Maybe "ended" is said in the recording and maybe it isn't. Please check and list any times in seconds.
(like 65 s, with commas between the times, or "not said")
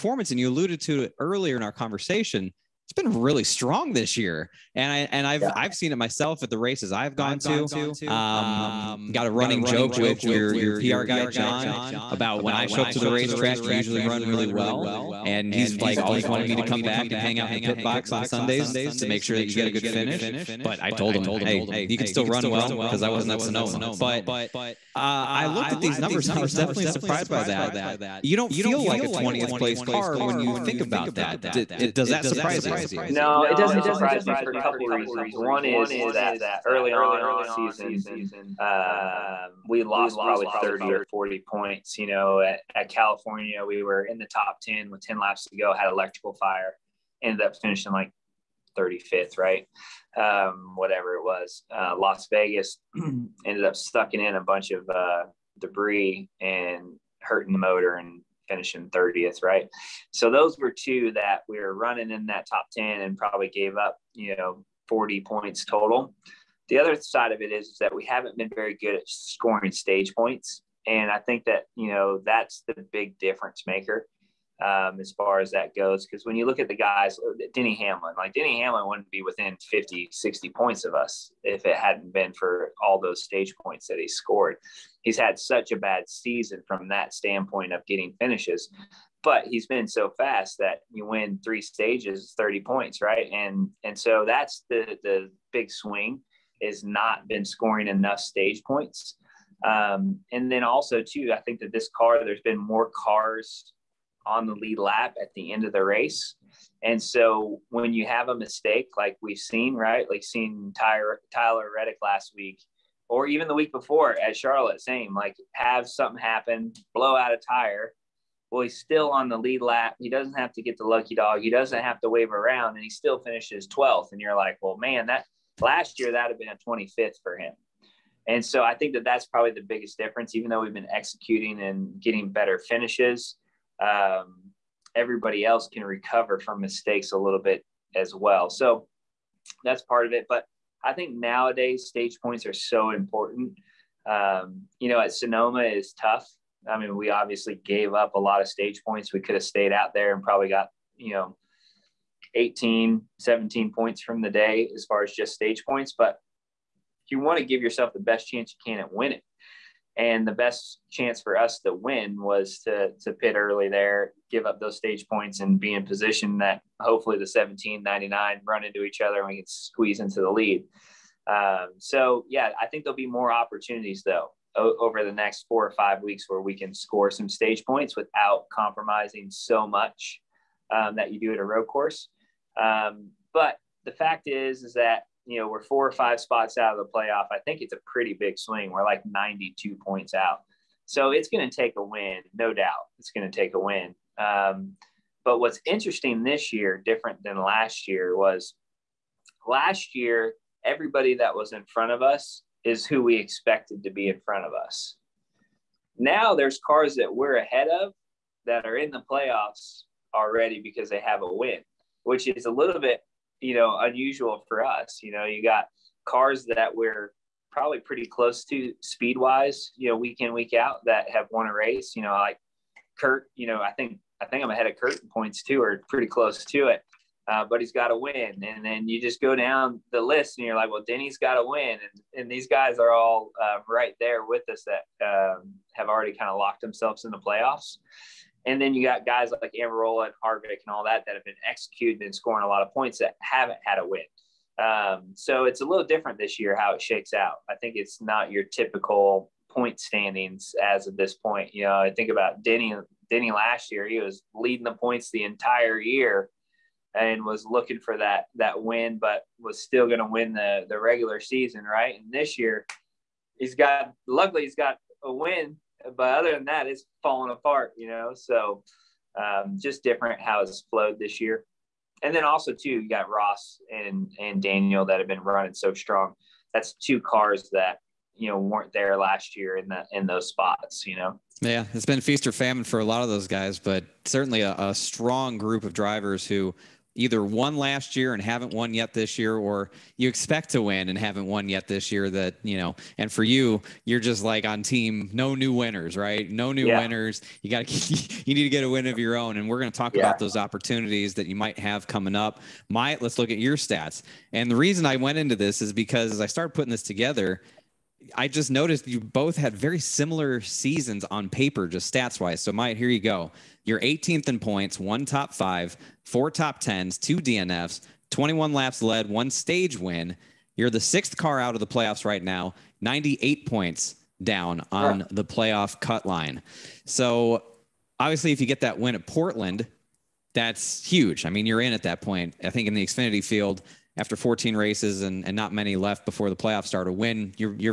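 47 s, 53 s.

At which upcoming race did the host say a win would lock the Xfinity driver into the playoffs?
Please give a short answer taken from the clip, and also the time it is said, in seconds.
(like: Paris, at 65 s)
Portland, at 329 s.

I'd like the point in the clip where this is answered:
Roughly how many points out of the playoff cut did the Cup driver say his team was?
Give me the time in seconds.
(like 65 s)
189 s.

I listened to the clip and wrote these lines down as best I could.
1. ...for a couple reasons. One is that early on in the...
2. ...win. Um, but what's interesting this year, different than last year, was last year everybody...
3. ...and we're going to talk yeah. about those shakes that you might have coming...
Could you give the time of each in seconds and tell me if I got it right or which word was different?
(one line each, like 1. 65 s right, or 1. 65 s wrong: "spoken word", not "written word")
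1. 34 s right
2. 193 s right
3. 299 s wrong: "opportunities", not "shakes".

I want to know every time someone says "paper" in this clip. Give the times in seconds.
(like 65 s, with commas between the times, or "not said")
311 s.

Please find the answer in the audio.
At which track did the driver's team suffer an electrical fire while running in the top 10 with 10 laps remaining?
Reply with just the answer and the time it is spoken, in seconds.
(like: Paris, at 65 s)
California, at 42 s.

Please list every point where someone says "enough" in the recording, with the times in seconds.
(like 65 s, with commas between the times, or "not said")
97 s.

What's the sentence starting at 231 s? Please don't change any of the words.
And, and these guys are all uh, right there with us that um, have already kind of locked themselves in the playoffs.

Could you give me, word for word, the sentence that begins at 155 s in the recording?
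But you want to give yourself the best chance you can at winning.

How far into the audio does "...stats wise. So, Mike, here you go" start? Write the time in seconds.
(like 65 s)
311 s.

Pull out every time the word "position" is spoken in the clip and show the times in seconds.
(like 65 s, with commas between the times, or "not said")
165 s.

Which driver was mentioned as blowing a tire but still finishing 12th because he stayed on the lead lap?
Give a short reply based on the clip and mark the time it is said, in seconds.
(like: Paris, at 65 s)
Tyler Reddick, at 111 s.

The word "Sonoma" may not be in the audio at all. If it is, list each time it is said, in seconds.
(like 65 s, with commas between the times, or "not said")
23 s, 145 s.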